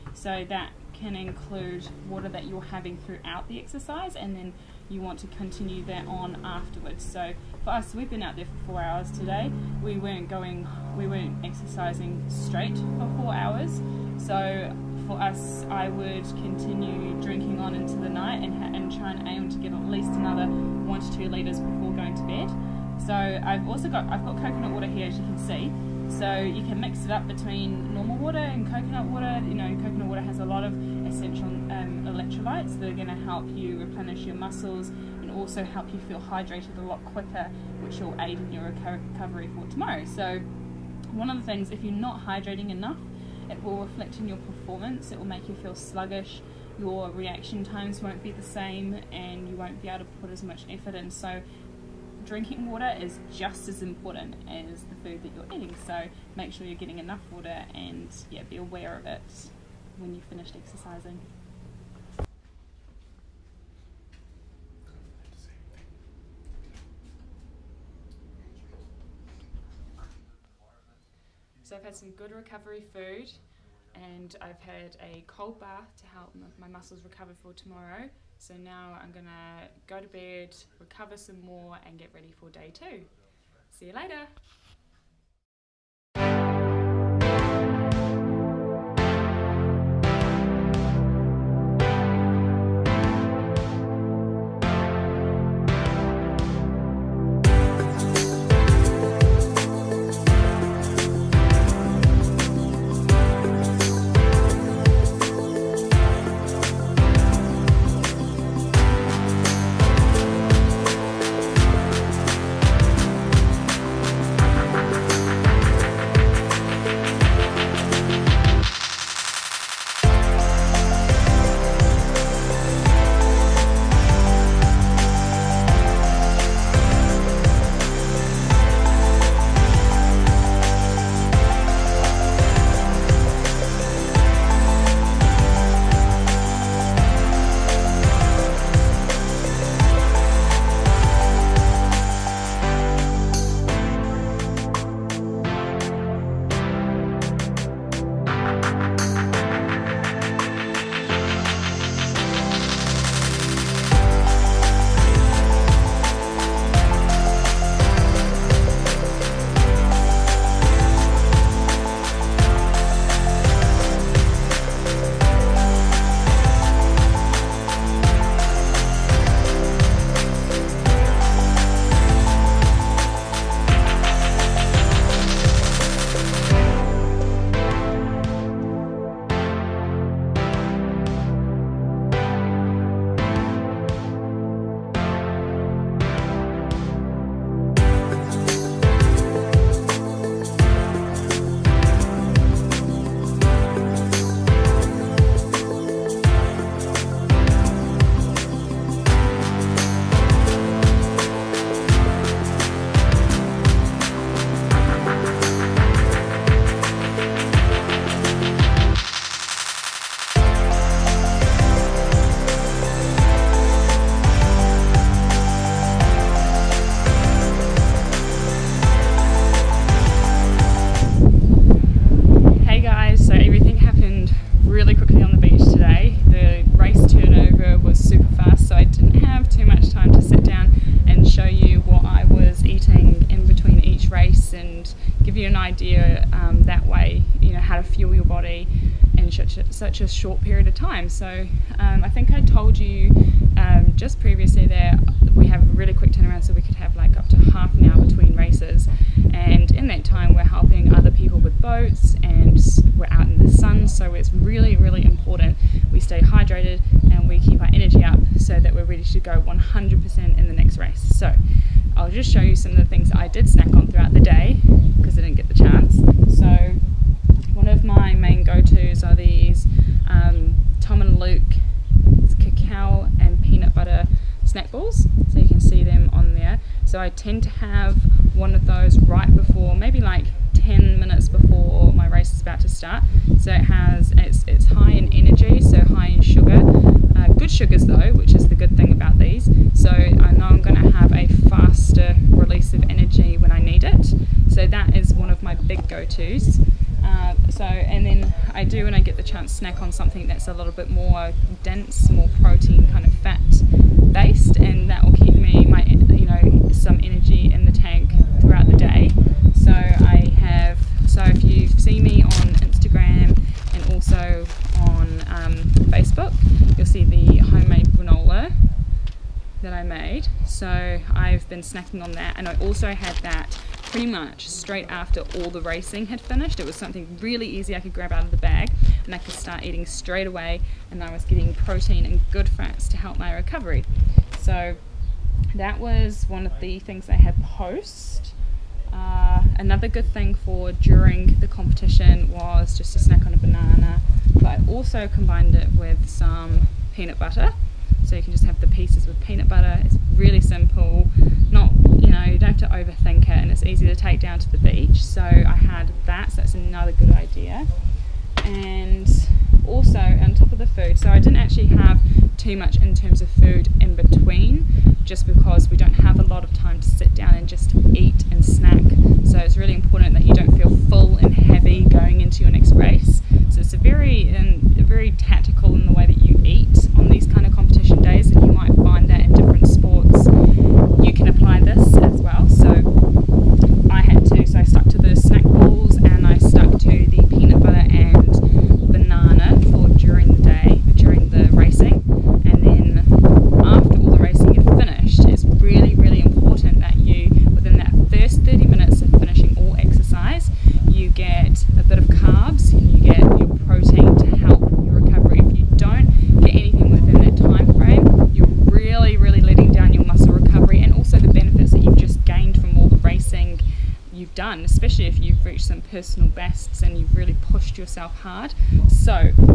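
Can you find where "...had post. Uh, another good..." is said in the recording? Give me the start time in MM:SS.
05:37.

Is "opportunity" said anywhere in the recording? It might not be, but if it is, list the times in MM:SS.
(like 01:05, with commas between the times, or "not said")
not said.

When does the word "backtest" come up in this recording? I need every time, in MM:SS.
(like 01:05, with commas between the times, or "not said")
not said.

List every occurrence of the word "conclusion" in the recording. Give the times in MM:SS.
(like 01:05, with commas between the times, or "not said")
not said.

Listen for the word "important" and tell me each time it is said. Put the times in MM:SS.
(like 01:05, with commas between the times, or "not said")
00:53, 04:15, 06:09.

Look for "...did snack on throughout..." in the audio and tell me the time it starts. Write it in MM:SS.
04:23.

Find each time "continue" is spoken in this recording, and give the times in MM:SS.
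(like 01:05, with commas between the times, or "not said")
00:05, 00:16.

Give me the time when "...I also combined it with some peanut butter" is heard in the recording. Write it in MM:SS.
05:44.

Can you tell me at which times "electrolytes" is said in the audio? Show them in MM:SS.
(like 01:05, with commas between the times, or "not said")
00:32.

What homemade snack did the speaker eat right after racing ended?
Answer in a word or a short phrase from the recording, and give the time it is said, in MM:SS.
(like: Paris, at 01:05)
Granola, at 05:17.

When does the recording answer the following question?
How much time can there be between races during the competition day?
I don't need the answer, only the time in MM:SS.
04:07.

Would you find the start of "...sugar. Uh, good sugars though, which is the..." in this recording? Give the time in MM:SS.
04:46.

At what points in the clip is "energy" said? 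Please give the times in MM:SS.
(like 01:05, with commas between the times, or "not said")
04:17, 04:45, 04:52, 05:07.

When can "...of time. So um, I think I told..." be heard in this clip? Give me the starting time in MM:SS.
04:00.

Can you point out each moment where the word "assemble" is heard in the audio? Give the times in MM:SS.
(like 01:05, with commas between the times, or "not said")
not said.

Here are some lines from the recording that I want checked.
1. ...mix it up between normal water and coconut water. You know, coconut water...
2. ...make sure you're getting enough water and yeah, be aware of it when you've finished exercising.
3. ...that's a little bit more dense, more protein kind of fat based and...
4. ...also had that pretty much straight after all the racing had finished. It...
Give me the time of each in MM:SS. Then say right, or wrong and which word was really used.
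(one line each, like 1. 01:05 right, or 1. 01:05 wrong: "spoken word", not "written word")
1. 00:26 right
2. 00:56 right
3. 05:00 right
4. 05:22 right.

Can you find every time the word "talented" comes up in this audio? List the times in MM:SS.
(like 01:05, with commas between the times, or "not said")
not said.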